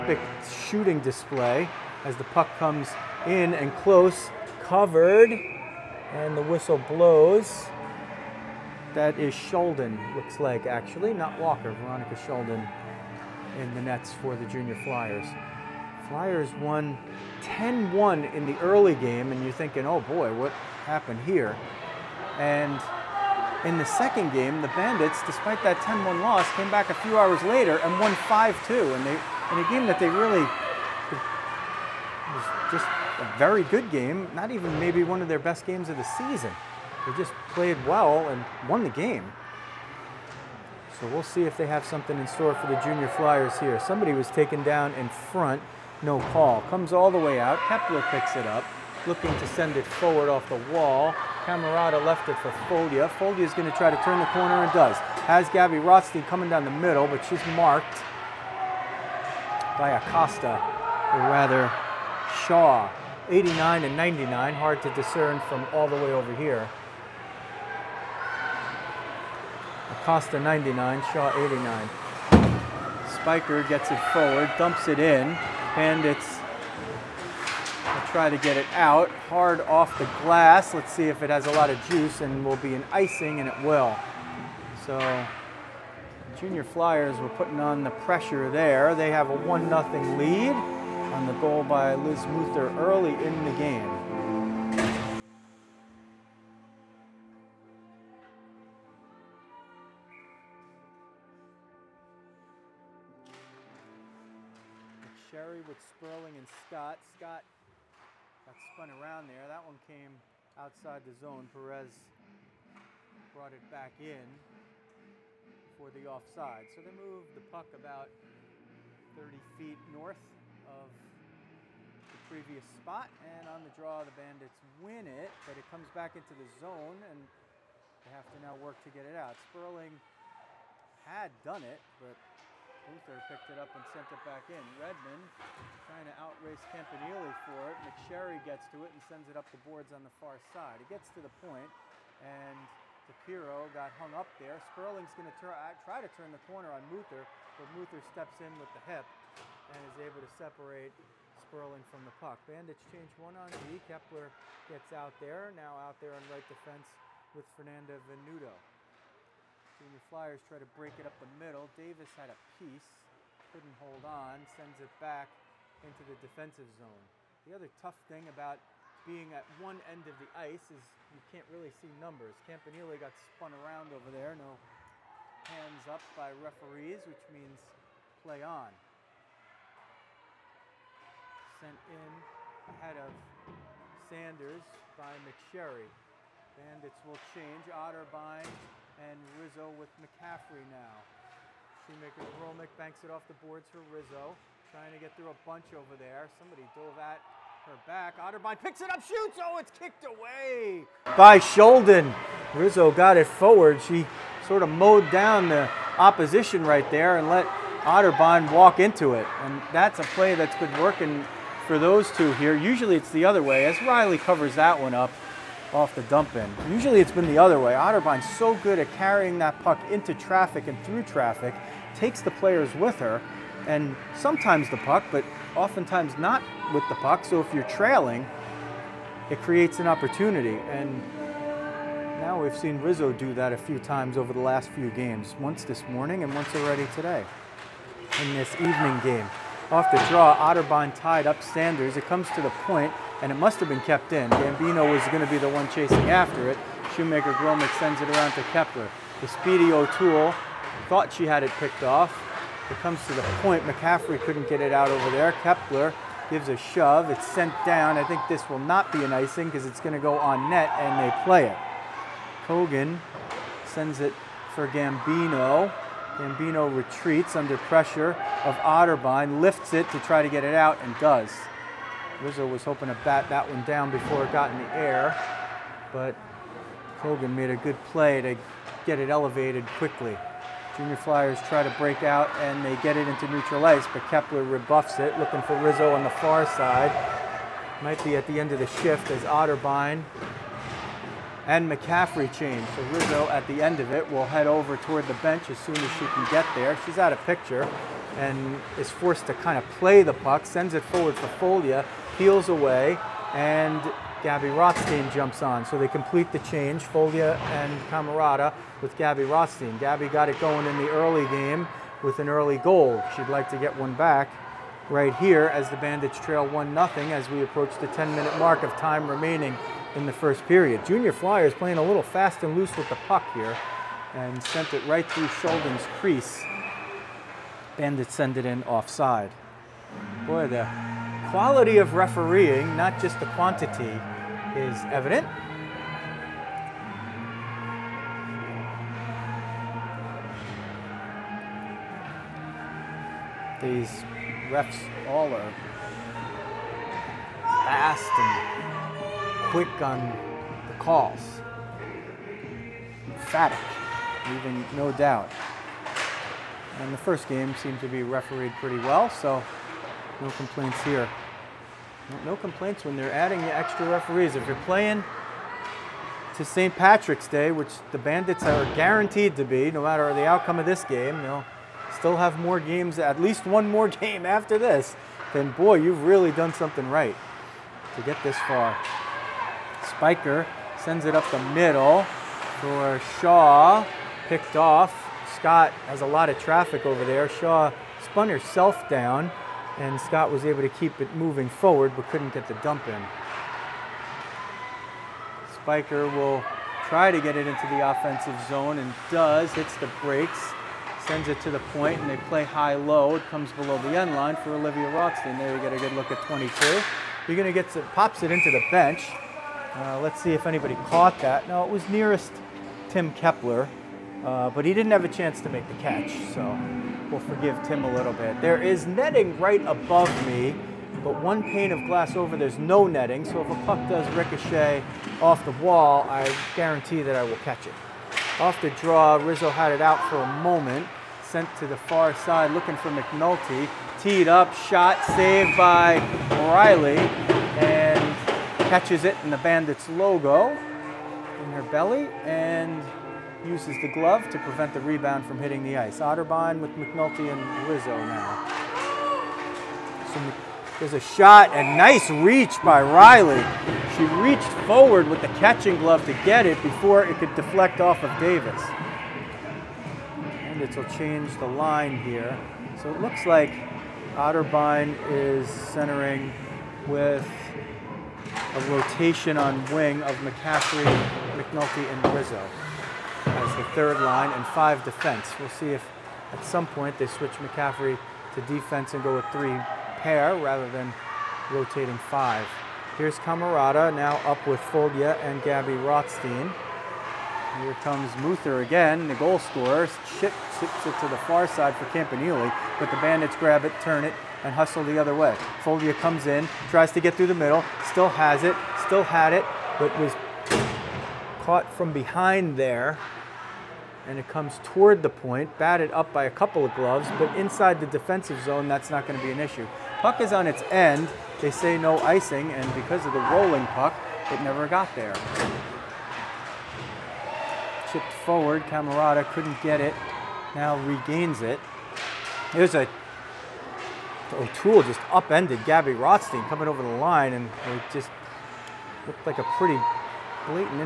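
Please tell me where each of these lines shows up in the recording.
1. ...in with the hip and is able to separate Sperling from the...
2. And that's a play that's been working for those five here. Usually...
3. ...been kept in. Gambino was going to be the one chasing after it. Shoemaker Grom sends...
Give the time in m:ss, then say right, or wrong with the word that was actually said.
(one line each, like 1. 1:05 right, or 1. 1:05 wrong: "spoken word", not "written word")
1. 2:28 right
2. 3:29 wrong: "two", not "five"
3. 4:03 right.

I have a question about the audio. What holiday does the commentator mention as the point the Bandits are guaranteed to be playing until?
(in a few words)
St. Patrick's Day.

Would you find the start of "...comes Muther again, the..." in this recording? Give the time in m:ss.
8:07.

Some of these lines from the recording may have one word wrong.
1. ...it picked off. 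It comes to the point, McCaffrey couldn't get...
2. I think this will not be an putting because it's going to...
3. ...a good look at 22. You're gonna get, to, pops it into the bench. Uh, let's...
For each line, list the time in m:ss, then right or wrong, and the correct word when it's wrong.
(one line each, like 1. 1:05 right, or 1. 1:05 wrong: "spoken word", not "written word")
1. 4:11 right
2. 4:17 wrong: "icing", not "putting"
3. 6:45 right.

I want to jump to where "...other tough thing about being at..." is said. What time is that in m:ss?
2:47.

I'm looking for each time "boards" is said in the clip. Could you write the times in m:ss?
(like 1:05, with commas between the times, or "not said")
2:19, 3:13.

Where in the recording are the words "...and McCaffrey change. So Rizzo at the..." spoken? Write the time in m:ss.
4:51.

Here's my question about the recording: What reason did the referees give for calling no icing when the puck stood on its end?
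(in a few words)
rolling puck.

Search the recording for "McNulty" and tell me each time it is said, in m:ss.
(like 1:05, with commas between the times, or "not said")
7:12, 7:26, 7:51.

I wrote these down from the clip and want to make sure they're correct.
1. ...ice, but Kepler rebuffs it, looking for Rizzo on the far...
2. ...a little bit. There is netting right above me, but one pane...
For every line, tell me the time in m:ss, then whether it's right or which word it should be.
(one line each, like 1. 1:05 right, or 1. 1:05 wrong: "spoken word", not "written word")
1. 4:43 right
2. 6:57 right.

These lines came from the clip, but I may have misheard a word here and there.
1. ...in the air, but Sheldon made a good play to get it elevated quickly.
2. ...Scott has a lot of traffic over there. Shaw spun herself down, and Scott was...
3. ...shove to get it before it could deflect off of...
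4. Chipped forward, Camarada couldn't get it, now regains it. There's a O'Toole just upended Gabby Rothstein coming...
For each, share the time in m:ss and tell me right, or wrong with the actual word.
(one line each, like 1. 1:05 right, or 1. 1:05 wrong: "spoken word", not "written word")
1. 4:34 wrong: "Kogan", not "Sheldon"
2. 6:25 right
3. 7:35 wrong: "glove", not "shove"
4. 8:37 right.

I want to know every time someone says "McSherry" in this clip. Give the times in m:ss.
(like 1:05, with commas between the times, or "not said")
2:17, 3:05.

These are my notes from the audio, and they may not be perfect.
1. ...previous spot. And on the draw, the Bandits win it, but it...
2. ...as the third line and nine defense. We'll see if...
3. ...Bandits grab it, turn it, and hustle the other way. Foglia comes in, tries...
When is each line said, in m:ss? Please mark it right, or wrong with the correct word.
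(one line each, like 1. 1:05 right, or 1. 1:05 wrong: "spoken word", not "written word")
1. 2:02 right
2. 7:53 wrong: "five", not "nine"
3. 8:12 right.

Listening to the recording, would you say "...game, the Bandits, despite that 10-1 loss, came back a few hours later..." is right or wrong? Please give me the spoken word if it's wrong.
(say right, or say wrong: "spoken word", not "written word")
right.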